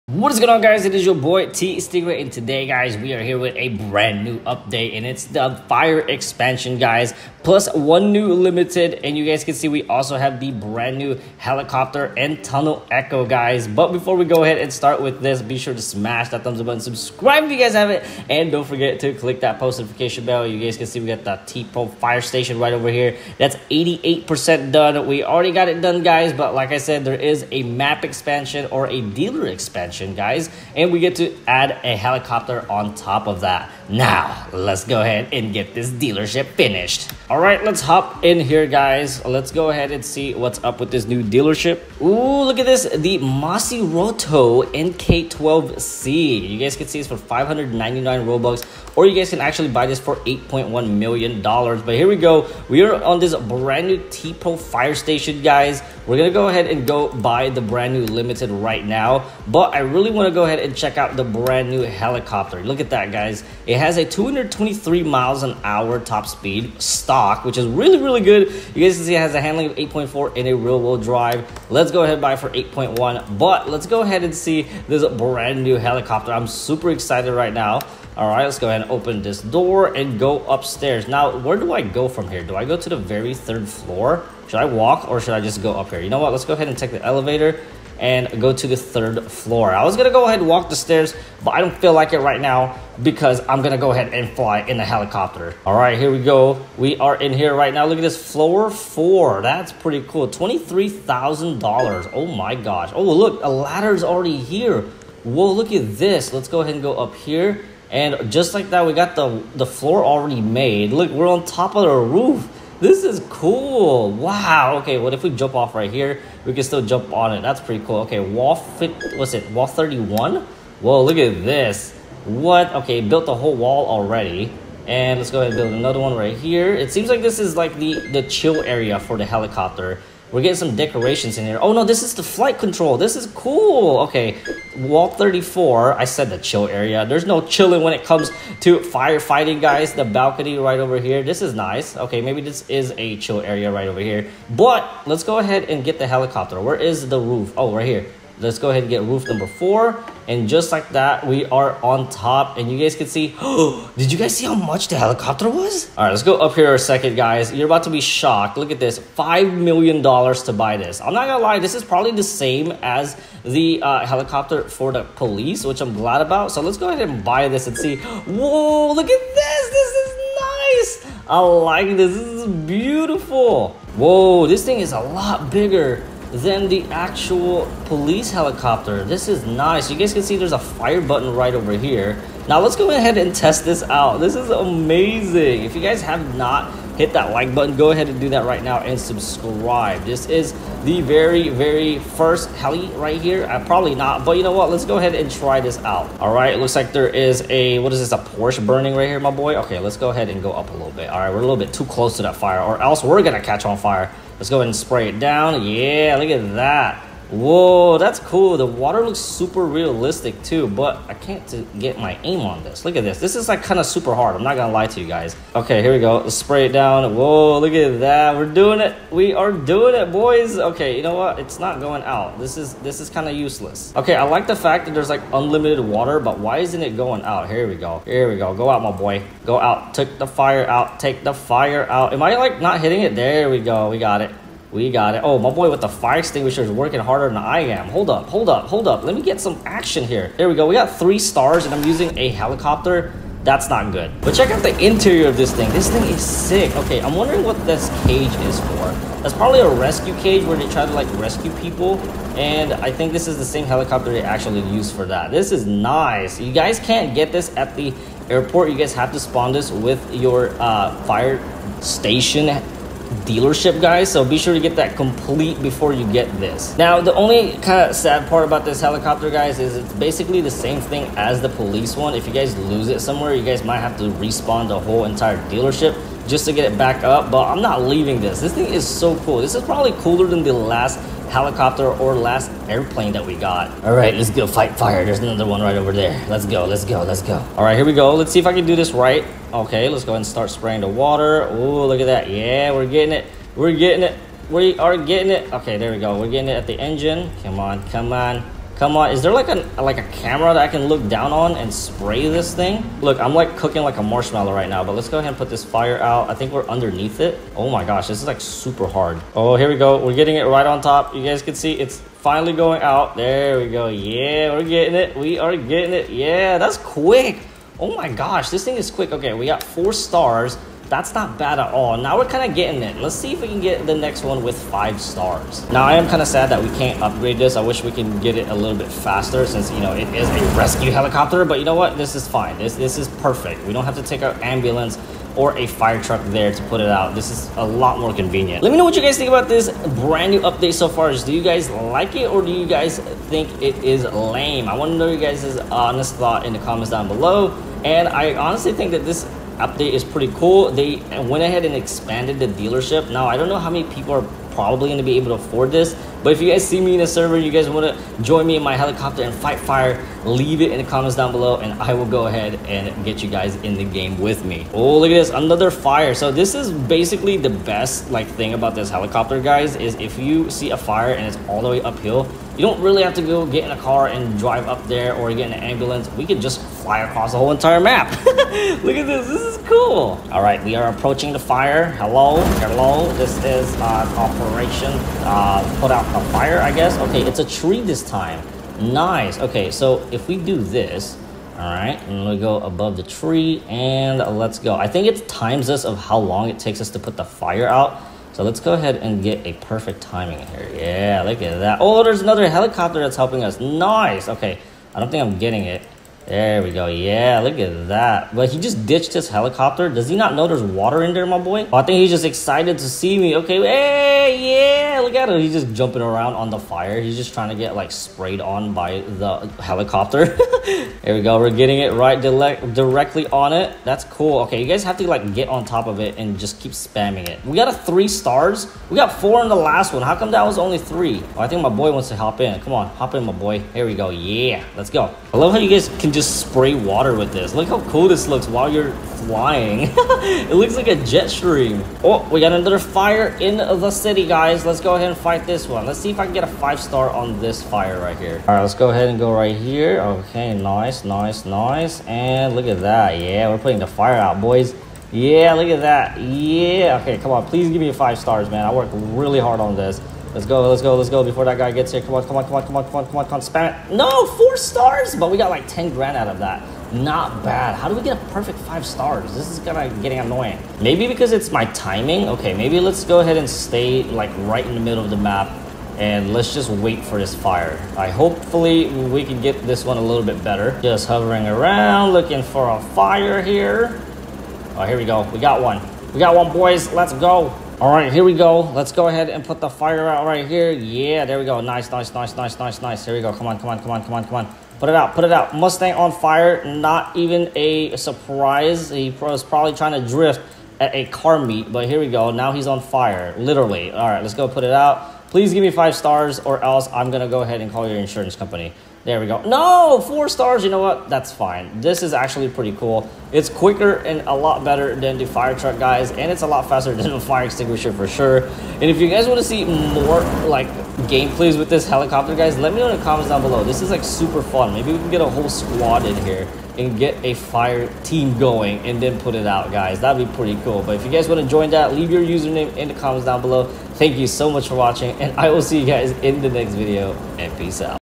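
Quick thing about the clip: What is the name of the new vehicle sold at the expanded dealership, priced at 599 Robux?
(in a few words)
Roto NK12C.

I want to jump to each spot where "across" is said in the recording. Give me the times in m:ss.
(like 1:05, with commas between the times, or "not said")
6:16.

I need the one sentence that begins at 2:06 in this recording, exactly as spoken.
It seems like this is like the, the chill area for the helicopter.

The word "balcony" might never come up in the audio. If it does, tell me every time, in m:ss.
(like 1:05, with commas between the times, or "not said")
2:20.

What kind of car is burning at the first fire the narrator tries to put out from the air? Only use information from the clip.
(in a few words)
Porsche.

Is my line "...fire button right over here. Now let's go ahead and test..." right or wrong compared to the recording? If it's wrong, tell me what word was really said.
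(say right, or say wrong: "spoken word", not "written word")
right.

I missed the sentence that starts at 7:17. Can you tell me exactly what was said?
Look how cool this looks while you're flying.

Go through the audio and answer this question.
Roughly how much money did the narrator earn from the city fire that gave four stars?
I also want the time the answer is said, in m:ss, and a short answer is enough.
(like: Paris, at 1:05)
10 grand, at 7:45.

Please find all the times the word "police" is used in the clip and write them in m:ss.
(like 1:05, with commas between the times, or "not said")
2:45, 2:57, 4:31.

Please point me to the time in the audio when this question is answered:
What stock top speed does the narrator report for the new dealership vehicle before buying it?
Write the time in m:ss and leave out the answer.
1:04.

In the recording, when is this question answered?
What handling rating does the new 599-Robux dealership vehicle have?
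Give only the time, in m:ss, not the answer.
1:09.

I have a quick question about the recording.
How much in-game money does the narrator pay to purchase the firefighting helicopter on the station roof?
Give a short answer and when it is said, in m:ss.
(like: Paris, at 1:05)
$5 million, at 2:38.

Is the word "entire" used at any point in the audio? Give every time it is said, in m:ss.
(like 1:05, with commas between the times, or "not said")
4:35, 6:17.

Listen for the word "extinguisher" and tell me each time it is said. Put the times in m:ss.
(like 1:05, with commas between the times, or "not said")
3:56, 8:37.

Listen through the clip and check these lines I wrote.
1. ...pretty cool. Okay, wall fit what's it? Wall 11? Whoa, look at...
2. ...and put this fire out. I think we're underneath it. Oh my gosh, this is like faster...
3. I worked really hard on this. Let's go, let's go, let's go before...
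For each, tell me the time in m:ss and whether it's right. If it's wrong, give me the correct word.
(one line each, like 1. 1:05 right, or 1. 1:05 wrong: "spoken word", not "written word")
1. 1:57 wrong: "31", not "11"
2. 5:05 wrong: "super", not "faster"
3. 7:38 right.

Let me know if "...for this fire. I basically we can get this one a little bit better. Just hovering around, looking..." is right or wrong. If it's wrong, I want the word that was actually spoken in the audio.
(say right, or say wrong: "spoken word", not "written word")
wrong: "hopefully", not "basically".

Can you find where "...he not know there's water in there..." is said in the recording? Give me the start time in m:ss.
6:50.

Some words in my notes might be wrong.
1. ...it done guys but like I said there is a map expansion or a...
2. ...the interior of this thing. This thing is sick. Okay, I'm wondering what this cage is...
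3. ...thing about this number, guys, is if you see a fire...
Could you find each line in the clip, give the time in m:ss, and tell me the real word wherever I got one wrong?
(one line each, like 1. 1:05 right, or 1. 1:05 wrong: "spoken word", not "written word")
1. 0:25 right
2. 4:04 right
3. 6:08 wrong: "helicopter", not "number".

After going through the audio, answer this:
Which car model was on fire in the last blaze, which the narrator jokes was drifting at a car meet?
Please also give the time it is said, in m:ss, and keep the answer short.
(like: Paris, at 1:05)
Mustang, at 8:15.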